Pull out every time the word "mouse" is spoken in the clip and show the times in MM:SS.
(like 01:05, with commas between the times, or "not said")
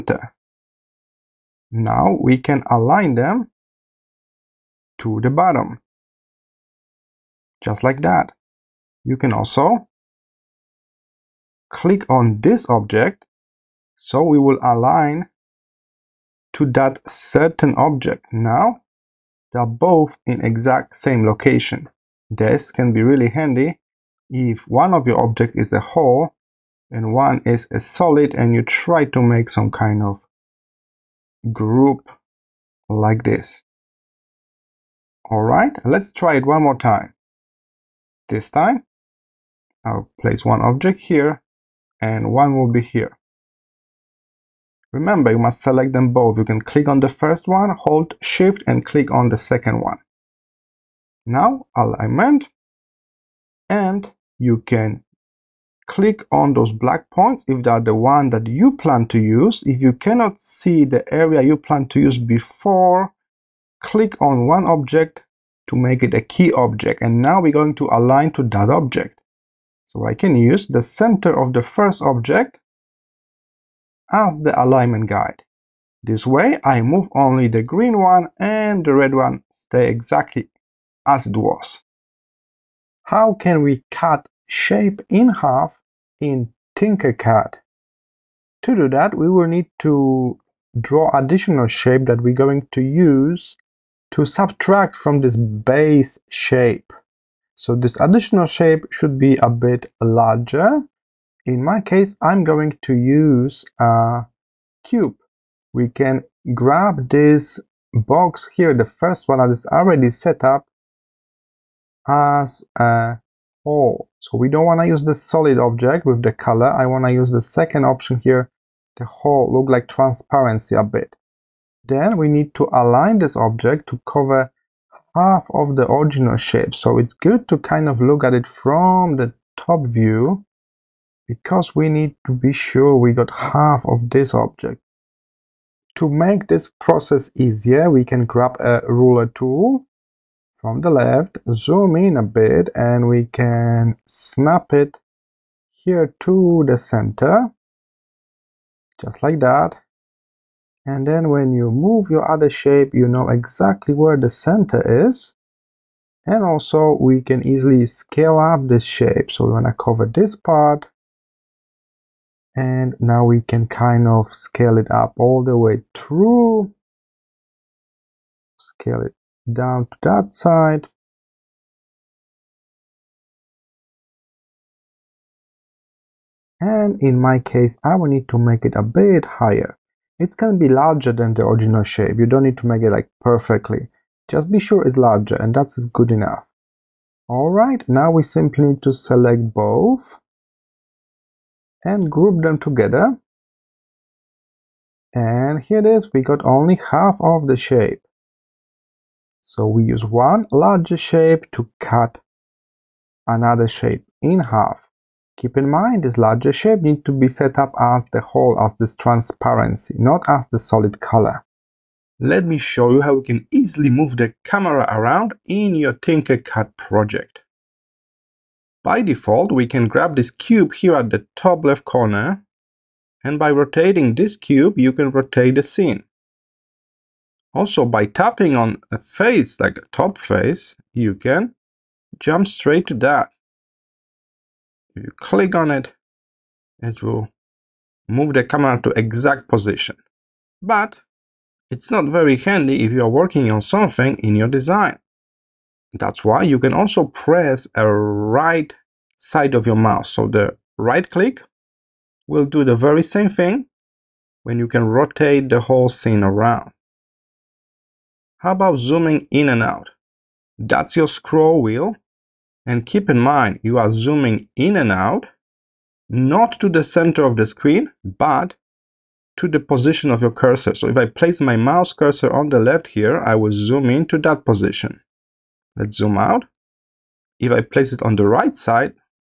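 04:09, 04:31.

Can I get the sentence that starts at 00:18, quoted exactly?
Now they are both in exact same location.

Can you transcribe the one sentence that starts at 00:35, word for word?
Alright, let's try it one more time.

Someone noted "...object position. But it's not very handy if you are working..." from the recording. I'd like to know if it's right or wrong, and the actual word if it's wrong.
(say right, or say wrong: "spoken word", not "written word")
wrong: "exact", not "object".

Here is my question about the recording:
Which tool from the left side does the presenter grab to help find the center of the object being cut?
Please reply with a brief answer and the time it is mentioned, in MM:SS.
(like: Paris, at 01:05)
Ruler tool, at 02:18.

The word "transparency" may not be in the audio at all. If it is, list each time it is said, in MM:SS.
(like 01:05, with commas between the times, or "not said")
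01:59, 03:28.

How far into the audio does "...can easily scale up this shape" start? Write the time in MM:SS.
02:37.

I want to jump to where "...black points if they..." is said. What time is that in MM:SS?
00:56.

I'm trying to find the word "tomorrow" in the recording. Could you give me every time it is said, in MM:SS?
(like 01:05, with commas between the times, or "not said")
not said.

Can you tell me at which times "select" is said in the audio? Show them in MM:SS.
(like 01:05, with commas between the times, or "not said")
00:45, 03:08.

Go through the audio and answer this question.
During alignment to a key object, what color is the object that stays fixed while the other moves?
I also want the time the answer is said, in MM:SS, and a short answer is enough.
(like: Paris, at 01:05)
Red, at 01:18.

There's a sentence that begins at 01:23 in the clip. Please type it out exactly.
How can we cut shape in half in Tinkercad?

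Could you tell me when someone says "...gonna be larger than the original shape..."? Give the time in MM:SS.
03:00.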